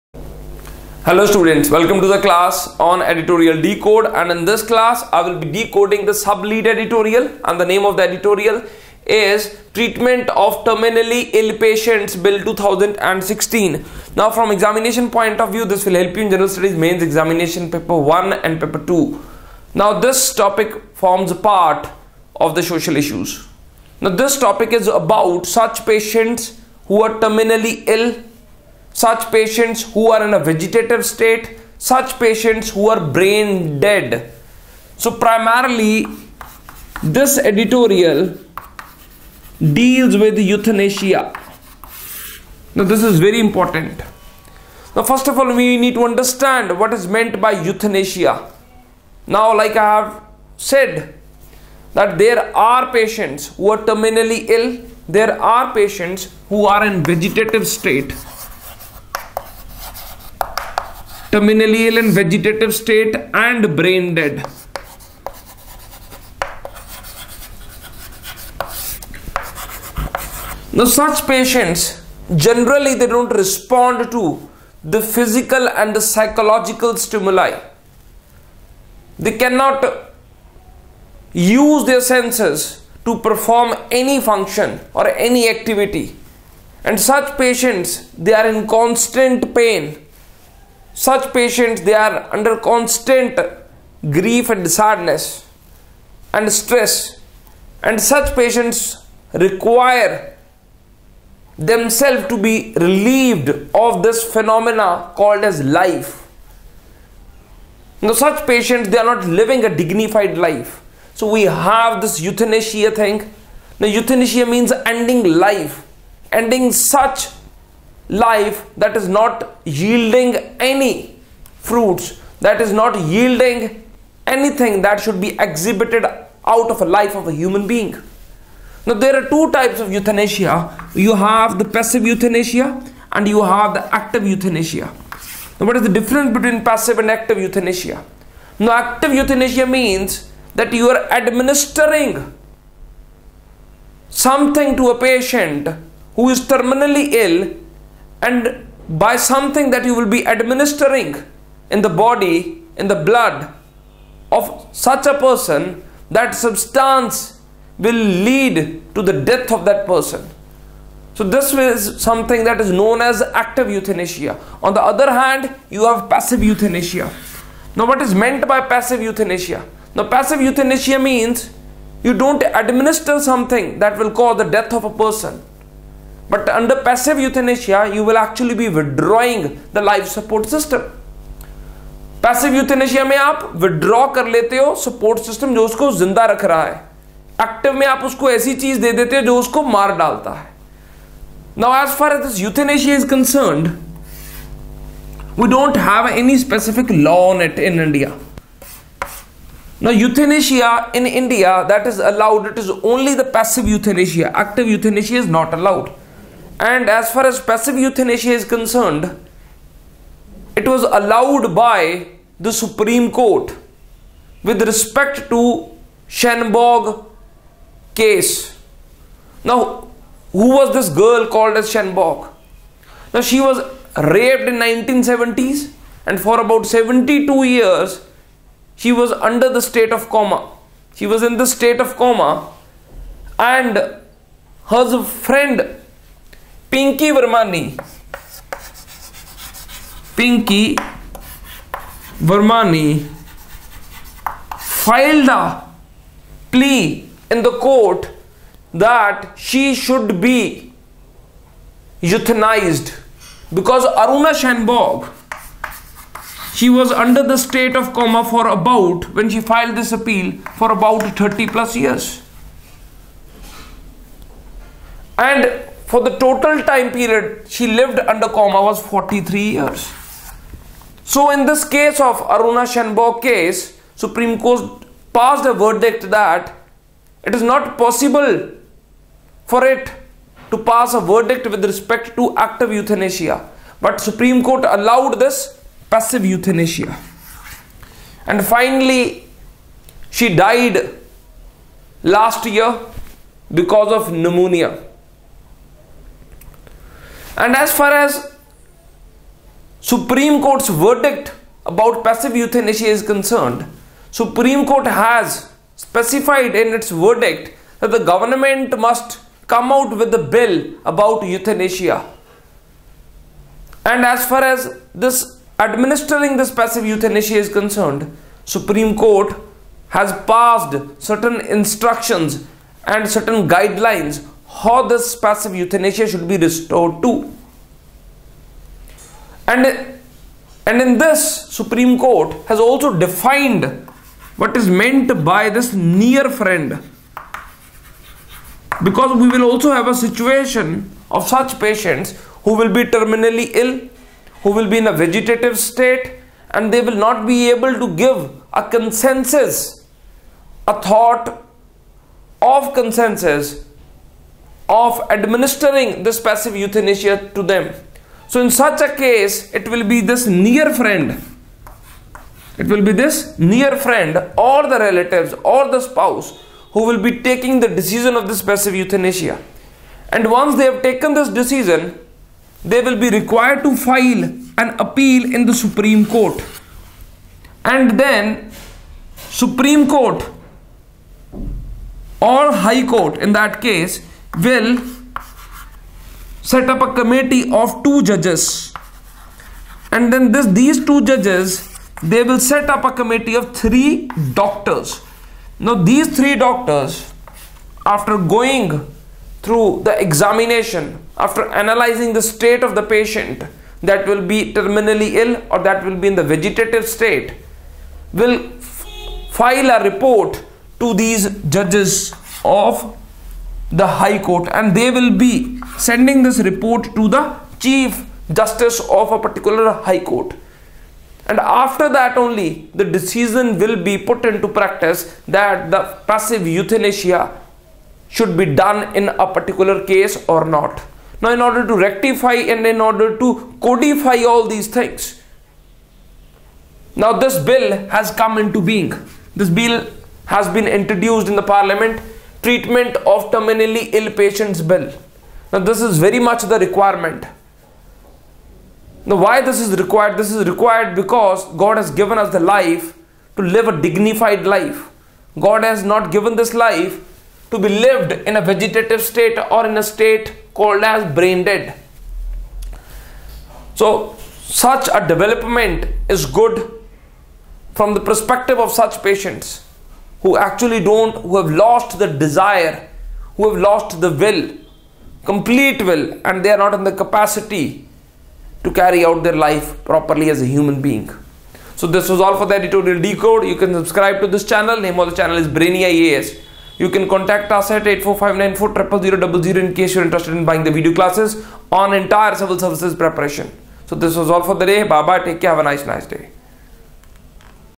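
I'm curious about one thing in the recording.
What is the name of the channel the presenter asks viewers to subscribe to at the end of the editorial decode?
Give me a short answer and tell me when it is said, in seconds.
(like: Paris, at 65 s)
Brainy IAS, at 485 s.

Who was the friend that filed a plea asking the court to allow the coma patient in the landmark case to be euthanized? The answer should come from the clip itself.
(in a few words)
Pinki Vermani.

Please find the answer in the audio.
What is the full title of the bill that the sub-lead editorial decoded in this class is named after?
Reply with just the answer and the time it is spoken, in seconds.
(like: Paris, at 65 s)
Treatment of Terminally Ill Patients Bill 2016, at 9 s.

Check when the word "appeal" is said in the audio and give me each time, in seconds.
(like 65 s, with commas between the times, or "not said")
259 s, 374 s.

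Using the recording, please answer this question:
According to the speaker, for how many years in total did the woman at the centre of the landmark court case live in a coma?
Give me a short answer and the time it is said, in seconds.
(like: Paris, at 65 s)
43, at 268 s.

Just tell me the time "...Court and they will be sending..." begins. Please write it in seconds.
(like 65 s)
414 s.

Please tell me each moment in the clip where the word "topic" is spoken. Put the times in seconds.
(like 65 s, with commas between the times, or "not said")
20 s, 24 s.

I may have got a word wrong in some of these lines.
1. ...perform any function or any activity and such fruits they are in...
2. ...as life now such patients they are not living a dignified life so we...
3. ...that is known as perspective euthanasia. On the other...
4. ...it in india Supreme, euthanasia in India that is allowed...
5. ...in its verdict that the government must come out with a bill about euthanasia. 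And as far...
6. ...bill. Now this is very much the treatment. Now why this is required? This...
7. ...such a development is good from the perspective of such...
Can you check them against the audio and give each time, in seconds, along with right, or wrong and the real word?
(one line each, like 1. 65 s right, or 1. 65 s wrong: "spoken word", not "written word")
1. 83 s wrong: "patients", not "fruits"
2. 105 s right
3. 162 s wrong: "active", not "perspective"
4. 197 s wrong: "Now", not "Supreme"
5. 306 s right
6. 444 s wrong: "requirement", not "treatment"
7. 464 s right.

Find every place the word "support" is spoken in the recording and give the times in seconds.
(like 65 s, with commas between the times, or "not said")
180 s, 184 s.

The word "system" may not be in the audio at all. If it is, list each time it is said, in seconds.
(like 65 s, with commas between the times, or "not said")
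180 s, 185 s.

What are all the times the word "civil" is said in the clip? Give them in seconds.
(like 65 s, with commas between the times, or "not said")
492 s.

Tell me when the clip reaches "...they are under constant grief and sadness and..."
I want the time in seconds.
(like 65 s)
91 s.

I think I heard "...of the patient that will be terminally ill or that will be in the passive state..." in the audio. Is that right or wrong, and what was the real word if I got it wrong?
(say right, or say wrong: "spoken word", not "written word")
wrong: "vegetative", not "passive".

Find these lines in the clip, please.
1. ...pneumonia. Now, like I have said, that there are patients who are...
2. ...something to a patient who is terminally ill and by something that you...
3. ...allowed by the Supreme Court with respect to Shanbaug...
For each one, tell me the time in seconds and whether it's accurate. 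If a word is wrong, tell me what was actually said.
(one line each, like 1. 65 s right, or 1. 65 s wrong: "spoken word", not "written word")
1. 47 s wrong: "euthanasia", not "pneumonia"
2. 144 s right
3. 210 s right.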